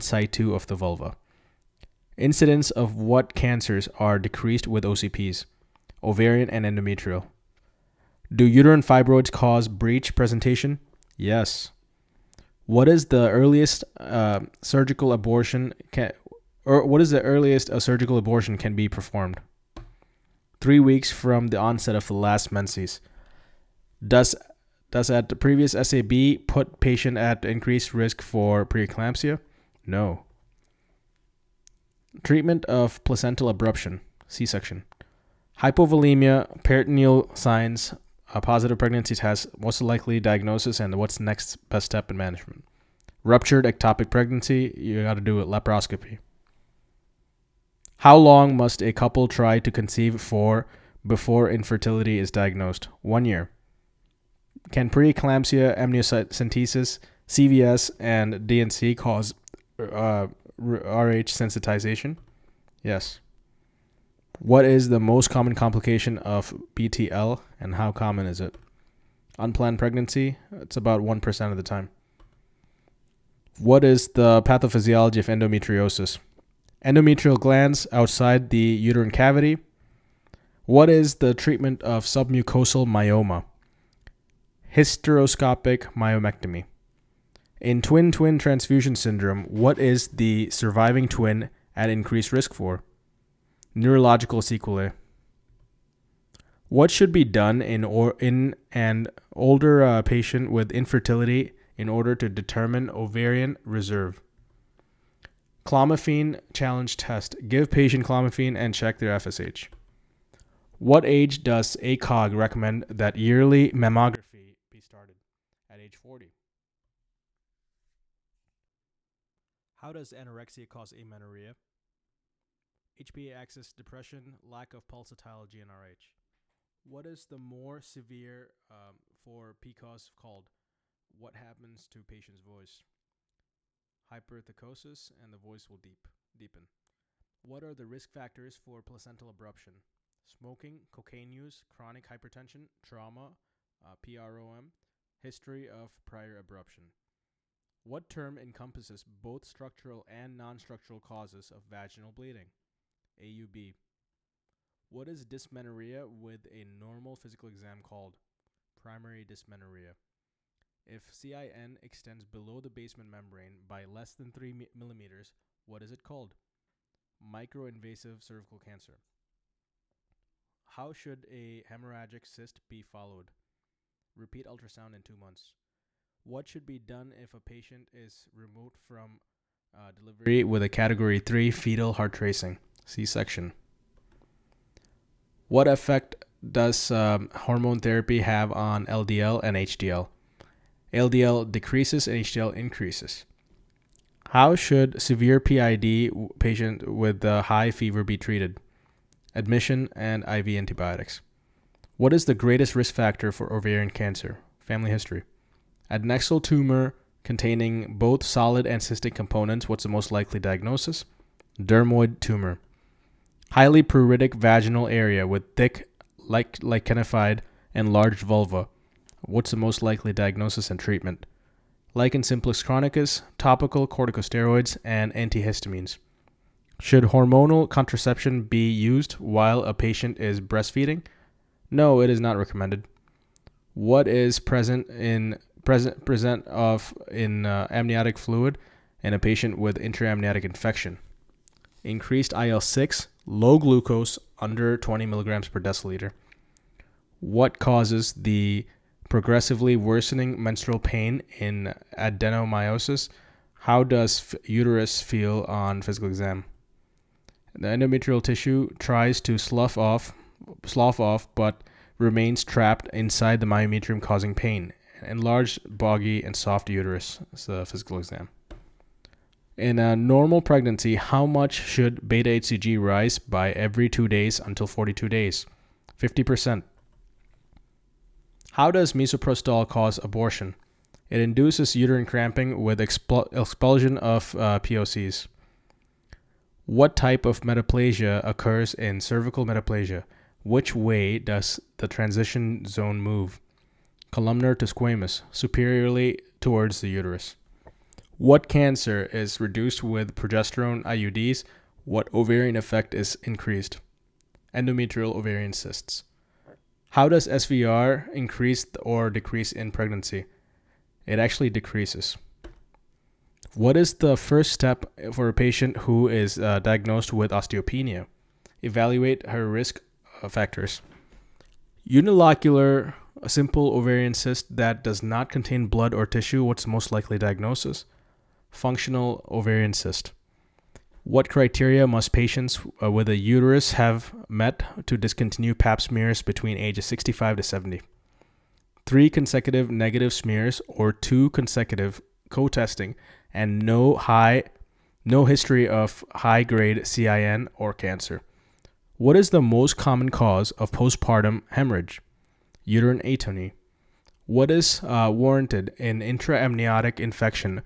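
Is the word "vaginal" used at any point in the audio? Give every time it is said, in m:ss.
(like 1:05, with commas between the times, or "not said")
2:31, 3:34.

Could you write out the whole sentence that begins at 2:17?
What are the risk factors for placental abruption?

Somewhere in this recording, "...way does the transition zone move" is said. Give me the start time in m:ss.
4:50.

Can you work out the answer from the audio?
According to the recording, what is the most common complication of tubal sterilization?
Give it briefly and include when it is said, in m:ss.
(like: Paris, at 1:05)
Unplanned pregnancy, at 1:09.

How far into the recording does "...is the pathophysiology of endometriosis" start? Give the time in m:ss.
1:13.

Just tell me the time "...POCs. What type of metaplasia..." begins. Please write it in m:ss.
4:44.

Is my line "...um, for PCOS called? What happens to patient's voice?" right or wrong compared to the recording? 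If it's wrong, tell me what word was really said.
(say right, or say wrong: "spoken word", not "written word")
right.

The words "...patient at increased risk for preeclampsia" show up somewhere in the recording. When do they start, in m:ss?
0:26.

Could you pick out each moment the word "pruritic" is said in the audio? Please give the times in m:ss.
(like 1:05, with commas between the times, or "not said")
3:33.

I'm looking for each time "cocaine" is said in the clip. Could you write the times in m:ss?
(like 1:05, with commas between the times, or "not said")
2:20.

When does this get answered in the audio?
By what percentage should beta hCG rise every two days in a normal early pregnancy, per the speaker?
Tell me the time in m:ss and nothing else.
4:35.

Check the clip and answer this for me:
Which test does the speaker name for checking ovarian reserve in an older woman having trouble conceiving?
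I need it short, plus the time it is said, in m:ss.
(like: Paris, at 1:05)
Clomiphene challenge test, at 1:45.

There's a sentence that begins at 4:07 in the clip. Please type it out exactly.
What causes the progressively worsening menstrual pain in adenomyosis?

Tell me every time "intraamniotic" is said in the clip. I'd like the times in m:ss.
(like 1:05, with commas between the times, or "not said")
3:59, 5:56.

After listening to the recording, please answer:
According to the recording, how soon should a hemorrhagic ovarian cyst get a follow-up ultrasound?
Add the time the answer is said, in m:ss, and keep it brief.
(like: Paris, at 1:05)
2 months, at 2:55.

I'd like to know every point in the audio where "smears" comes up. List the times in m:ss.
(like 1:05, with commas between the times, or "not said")
5:35, 5:40.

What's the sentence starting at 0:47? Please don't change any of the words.
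How long must a couple try to conceive for before infertility is diagnosed?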